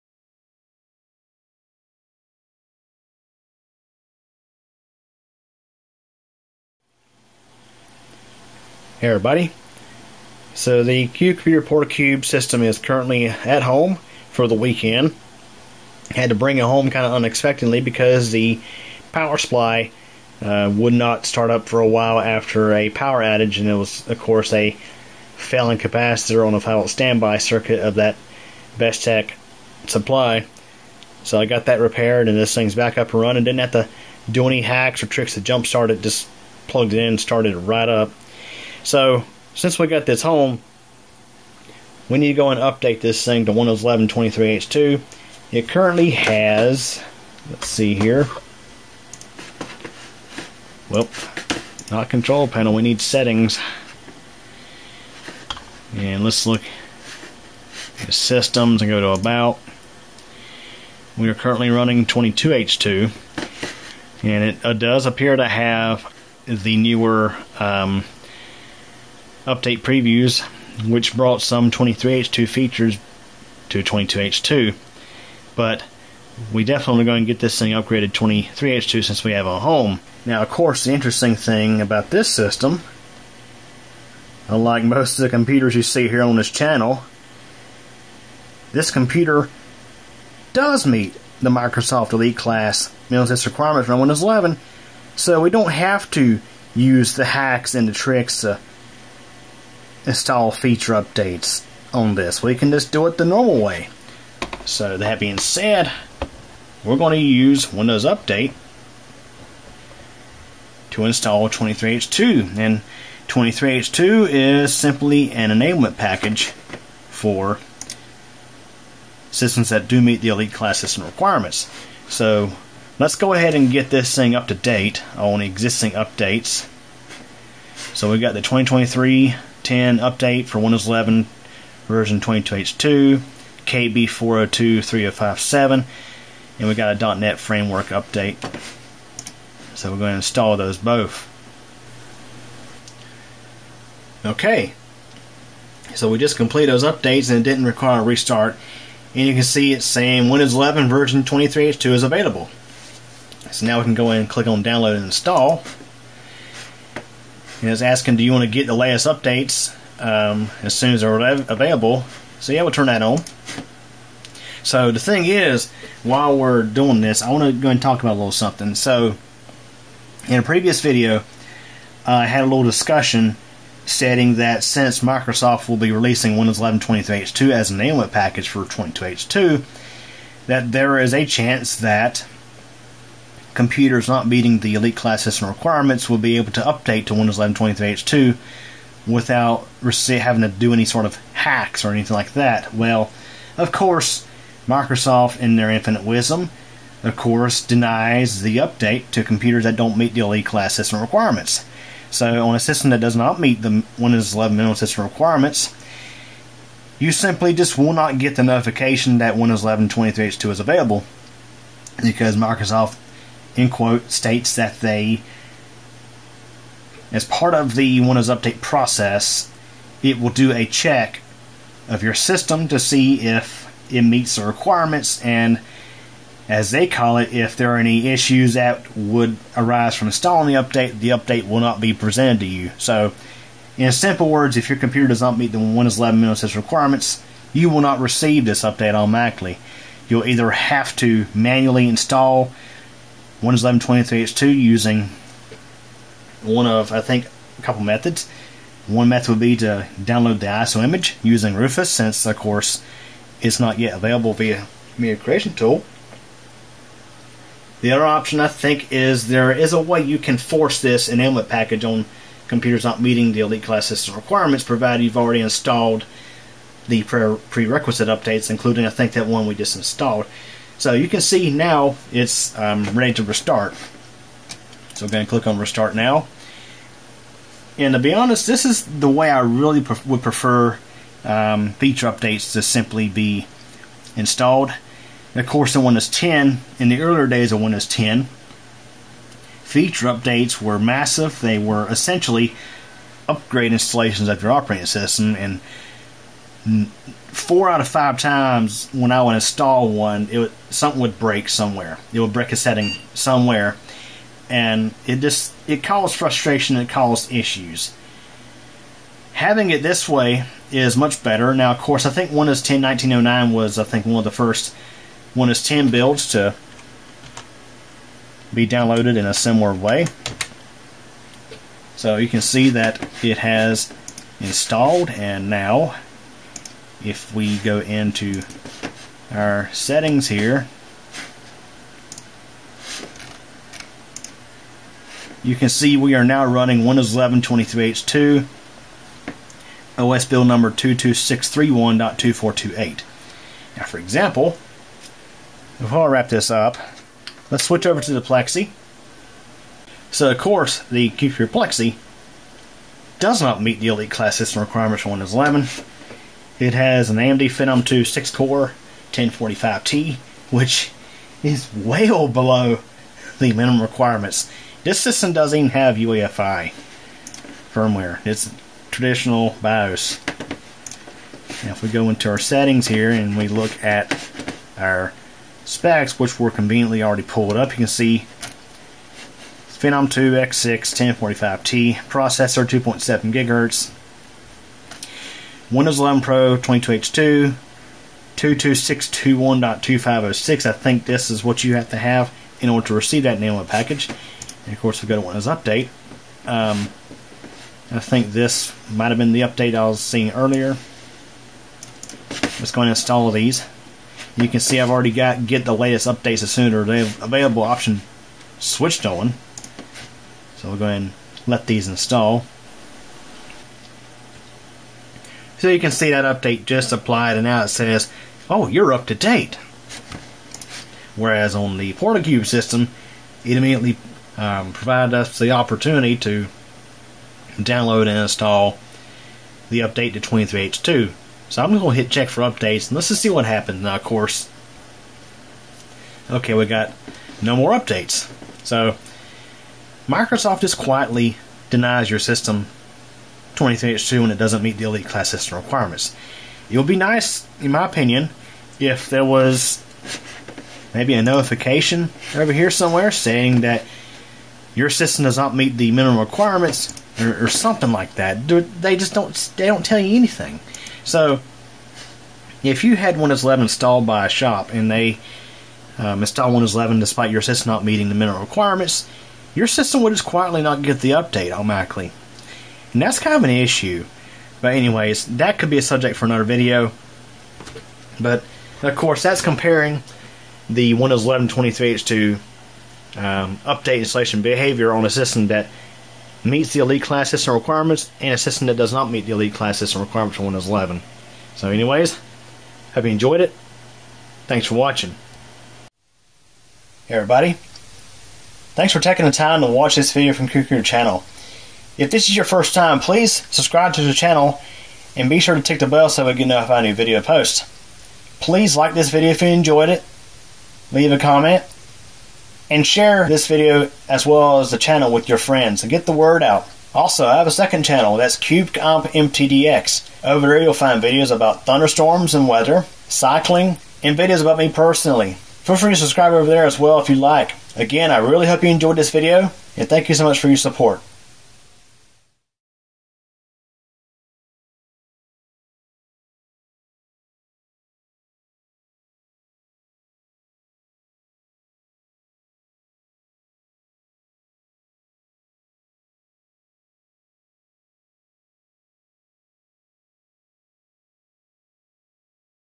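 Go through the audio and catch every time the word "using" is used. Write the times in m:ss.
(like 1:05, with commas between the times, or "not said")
4:04, 4:11.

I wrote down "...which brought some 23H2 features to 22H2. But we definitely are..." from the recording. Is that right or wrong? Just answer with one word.
right.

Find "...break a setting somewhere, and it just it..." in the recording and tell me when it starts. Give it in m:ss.
5:02.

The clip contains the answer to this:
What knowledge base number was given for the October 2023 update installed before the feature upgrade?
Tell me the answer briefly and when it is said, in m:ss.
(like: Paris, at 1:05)
KB 4023057, at 2:13.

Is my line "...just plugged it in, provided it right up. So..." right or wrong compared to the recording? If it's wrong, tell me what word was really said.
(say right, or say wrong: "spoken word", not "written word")
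wrong: "started", not "provided".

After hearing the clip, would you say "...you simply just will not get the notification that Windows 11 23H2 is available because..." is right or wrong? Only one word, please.
right.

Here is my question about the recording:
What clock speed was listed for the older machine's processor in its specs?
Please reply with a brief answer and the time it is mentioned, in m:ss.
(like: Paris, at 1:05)
2.7 gigahertz, at 6:22.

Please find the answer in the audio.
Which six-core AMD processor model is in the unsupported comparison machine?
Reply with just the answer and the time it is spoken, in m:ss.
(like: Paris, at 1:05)
Phenom 2 1045T, at 5:57.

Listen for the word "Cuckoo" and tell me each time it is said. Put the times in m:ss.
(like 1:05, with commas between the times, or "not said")
8:20.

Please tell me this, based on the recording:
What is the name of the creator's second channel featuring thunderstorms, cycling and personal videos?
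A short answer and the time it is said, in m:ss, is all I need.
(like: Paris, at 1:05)
CubeComp MTDX, at 8:38.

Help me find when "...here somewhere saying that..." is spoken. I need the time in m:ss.
7:32.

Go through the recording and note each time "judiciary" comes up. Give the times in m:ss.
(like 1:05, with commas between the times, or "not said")
not said.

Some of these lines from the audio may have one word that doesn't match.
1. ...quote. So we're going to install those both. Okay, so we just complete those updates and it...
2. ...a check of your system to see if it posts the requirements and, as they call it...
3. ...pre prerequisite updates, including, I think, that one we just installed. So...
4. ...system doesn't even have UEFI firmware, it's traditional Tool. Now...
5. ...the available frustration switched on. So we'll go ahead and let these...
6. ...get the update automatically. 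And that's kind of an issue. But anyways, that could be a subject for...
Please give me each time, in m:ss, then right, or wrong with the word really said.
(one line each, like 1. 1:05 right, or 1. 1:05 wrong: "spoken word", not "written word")
1. 2:17 wrong: "update", not "quote"
2. 3:40 wrong: "meets", not "posts"
3. 4:27 right
4. 6:04 wrong: "BIOS", not "Tool"
5. 6:46 wrong: "option", not "frustration"
6. 7:50 right.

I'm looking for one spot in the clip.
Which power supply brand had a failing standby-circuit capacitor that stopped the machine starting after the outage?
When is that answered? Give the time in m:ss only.
0:28.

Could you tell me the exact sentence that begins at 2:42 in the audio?
So yeah, we'll turn that on.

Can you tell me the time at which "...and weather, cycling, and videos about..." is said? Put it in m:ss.
8:42.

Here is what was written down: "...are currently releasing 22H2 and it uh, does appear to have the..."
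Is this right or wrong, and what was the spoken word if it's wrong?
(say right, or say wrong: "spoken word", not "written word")
wrong: "running", not "releasing".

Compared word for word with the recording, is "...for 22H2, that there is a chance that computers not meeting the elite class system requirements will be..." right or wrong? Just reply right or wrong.
right.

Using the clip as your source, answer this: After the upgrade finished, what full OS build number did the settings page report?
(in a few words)
22631.2428.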